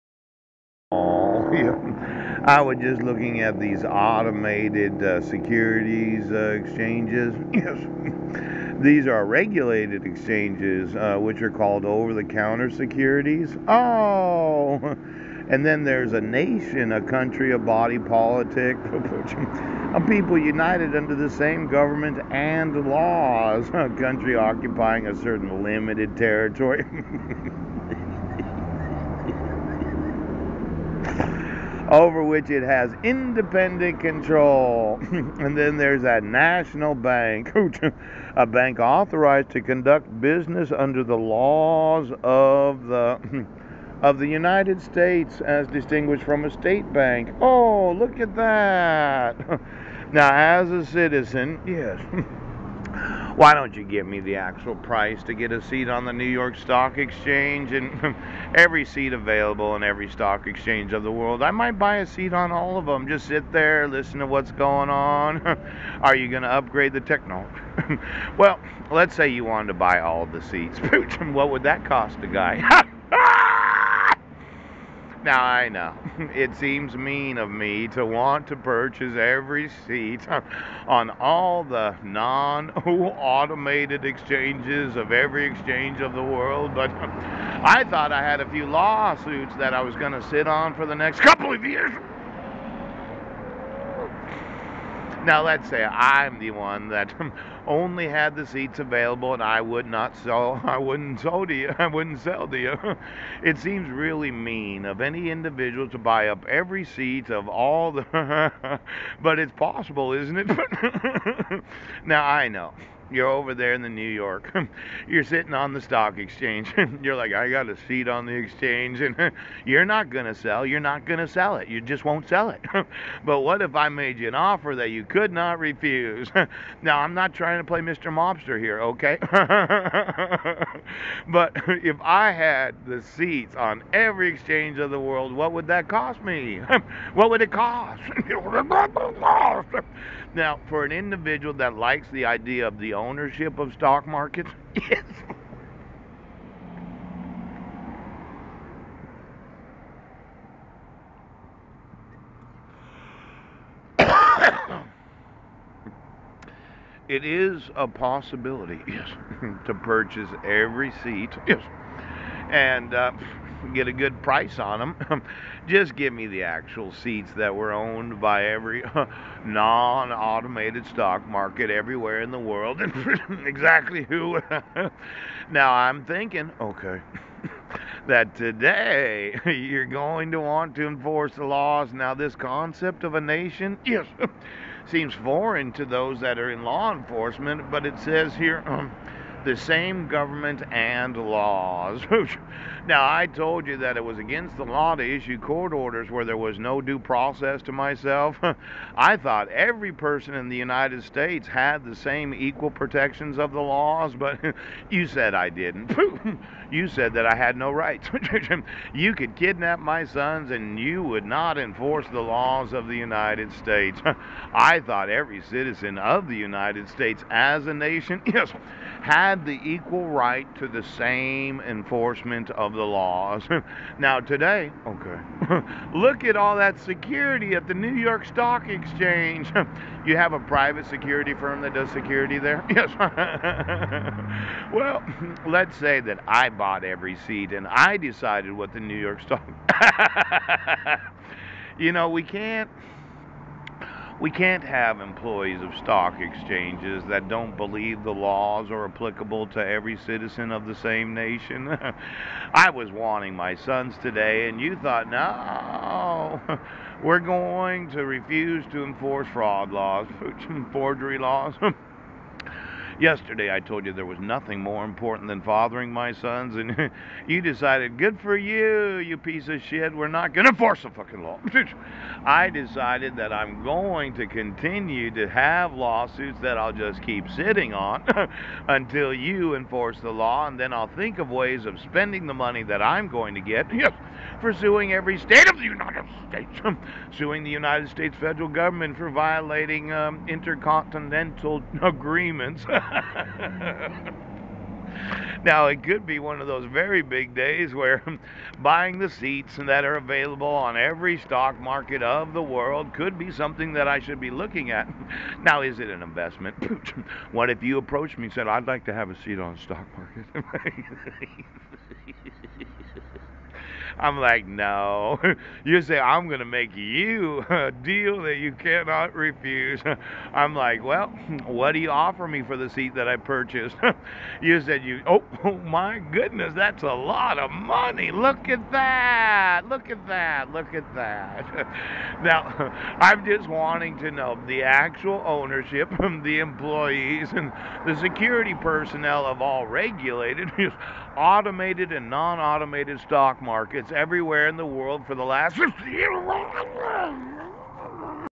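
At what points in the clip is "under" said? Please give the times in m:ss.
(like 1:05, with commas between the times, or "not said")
0:20, 0:40.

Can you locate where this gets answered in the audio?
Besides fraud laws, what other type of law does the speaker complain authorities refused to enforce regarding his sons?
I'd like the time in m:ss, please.
4:20.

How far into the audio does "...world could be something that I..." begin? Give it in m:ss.
5:02.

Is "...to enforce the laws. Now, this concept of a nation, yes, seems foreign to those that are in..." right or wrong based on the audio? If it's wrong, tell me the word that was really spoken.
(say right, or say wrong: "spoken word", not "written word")
right.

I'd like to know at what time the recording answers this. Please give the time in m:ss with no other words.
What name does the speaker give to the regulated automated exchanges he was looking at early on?
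0:11.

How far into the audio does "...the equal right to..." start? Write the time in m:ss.
3:39.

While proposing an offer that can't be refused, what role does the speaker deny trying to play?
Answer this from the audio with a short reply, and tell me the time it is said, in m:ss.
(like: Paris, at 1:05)
Mr. Mobster, at 2:07.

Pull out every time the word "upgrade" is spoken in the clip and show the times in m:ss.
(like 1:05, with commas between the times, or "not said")
1:06.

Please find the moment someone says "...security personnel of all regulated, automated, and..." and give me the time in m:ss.
5:37.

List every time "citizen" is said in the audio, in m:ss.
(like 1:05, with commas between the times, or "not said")
0:50, 3:35, 4:09.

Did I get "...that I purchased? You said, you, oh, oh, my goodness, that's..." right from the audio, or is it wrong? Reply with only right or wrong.
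right.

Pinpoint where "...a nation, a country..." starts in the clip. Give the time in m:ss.
0:16.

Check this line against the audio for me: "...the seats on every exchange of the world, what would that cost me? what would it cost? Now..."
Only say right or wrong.
right.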